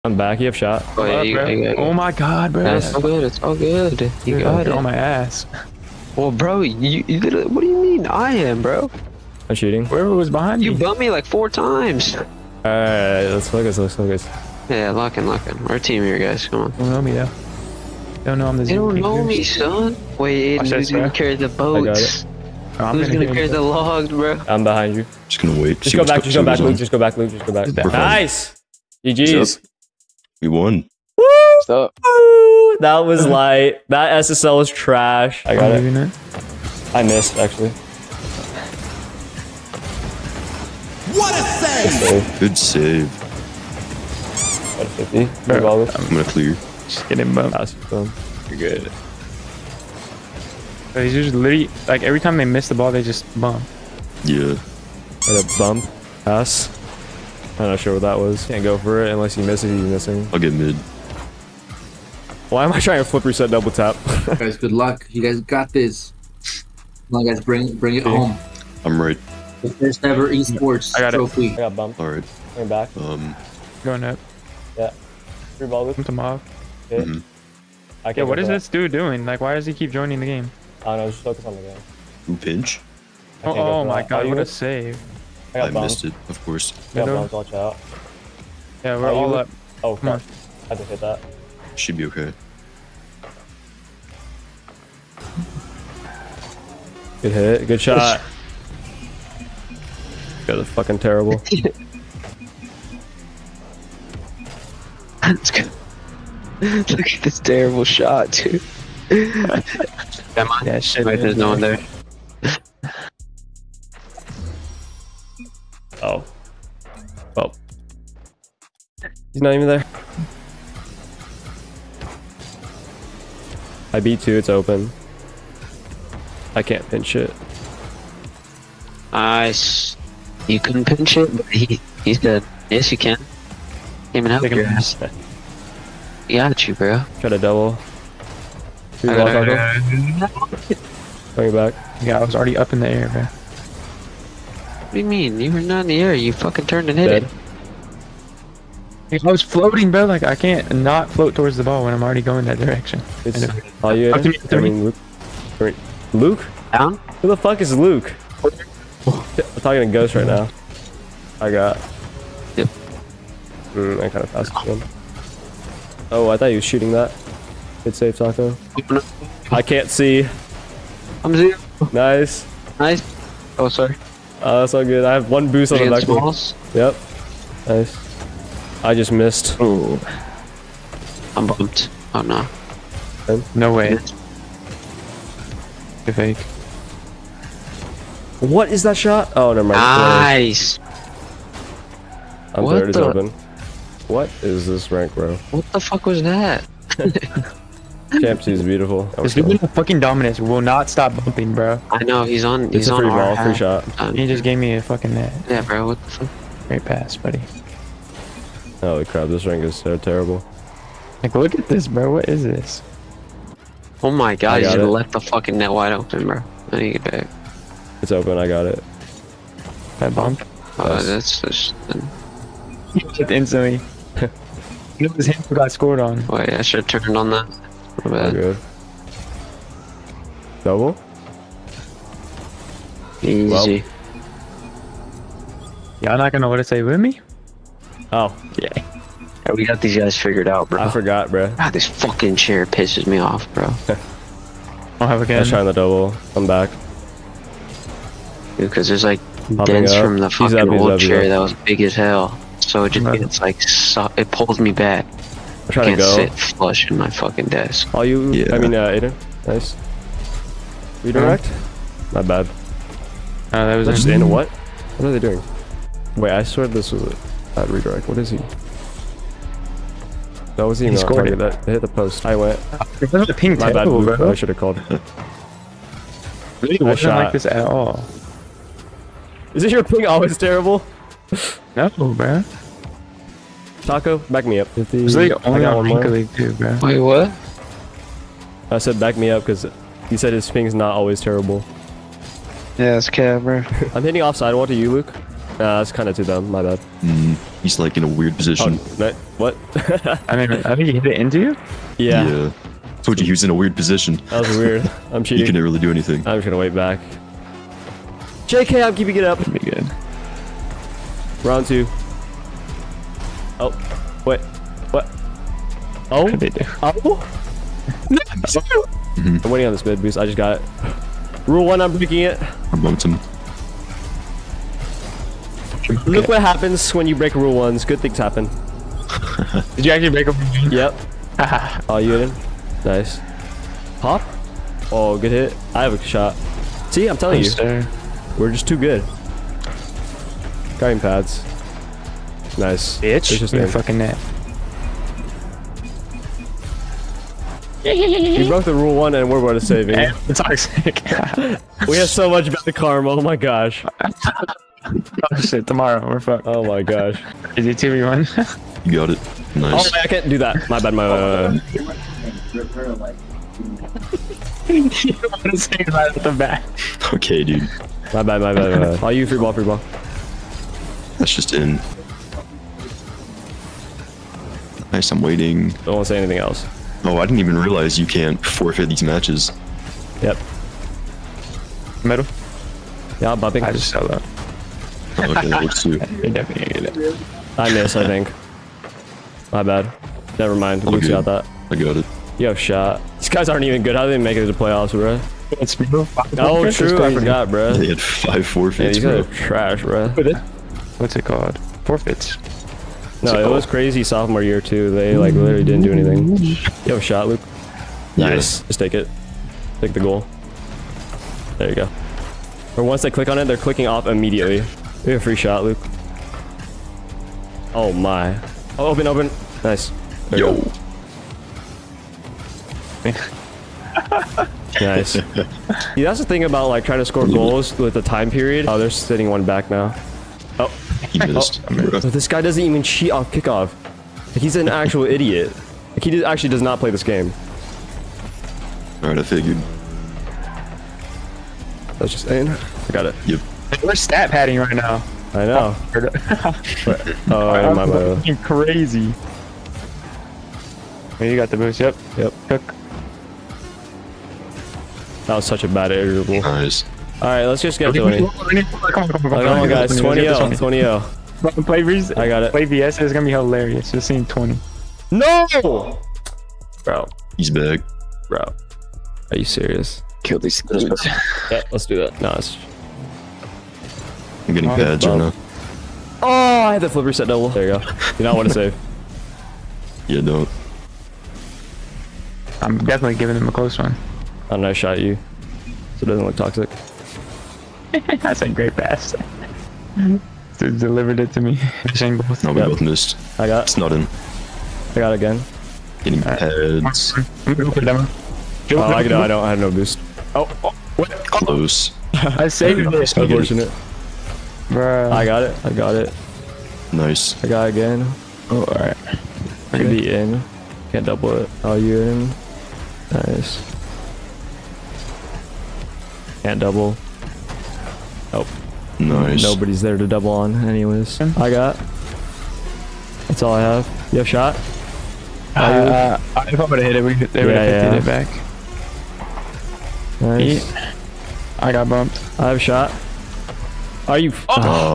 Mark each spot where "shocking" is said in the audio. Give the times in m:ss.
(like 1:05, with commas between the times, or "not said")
not said.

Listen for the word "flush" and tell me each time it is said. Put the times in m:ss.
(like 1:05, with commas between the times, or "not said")
4:16.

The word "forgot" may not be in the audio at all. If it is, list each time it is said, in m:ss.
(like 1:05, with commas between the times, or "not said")
4:00, 6:37.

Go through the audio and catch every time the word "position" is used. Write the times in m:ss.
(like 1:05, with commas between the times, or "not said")
4:58, 5:03.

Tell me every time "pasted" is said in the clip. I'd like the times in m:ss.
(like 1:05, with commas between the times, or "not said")
not said.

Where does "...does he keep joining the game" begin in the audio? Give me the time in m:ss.
1:19.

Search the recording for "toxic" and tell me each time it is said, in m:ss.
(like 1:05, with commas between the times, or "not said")
5:50, 8:06.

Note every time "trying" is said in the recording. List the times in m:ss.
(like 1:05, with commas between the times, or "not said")
1:02, 4:15, 7:06.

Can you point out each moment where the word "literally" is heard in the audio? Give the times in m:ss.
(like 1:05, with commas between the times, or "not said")
0:07, 0:51, 6:45.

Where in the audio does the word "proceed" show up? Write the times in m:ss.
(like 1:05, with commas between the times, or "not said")
not said.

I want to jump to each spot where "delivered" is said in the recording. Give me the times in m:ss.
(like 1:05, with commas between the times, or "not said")
8:10.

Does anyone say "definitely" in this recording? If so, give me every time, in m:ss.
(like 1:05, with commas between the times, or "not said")
6:25, 8:02.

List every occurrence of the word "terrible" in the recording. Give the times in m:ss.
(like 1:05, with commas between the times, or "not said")
1:40, 1:47, 3:29, 4:40, 4:51.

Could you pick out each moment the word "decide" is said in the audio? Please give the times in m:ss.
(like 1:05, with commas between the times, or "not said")
not said.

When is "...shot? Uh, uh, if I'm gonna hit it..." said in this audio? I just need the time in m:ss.
8:44.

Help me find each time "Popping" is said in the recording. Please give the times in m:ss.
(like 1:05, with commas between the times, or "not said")
4:09.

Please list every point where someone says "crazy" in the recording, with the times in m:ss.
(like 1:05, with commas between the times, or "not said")
6:43, 7:28.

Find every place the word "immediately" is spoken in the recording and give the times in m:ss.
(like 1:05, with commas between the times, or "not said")
6:54.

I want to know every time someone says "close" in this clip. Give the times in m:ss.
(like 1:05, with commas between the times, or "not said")
8:03, 8:21.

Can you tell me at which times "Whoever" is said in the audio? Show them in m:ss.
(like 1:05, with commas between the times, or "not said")
0:09.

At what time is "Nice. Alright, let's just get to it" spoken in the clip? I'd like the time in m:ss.
7:36.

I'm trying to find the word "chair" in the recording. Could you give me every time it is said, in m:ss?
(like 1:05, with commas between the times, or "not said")
4:02, 4:10.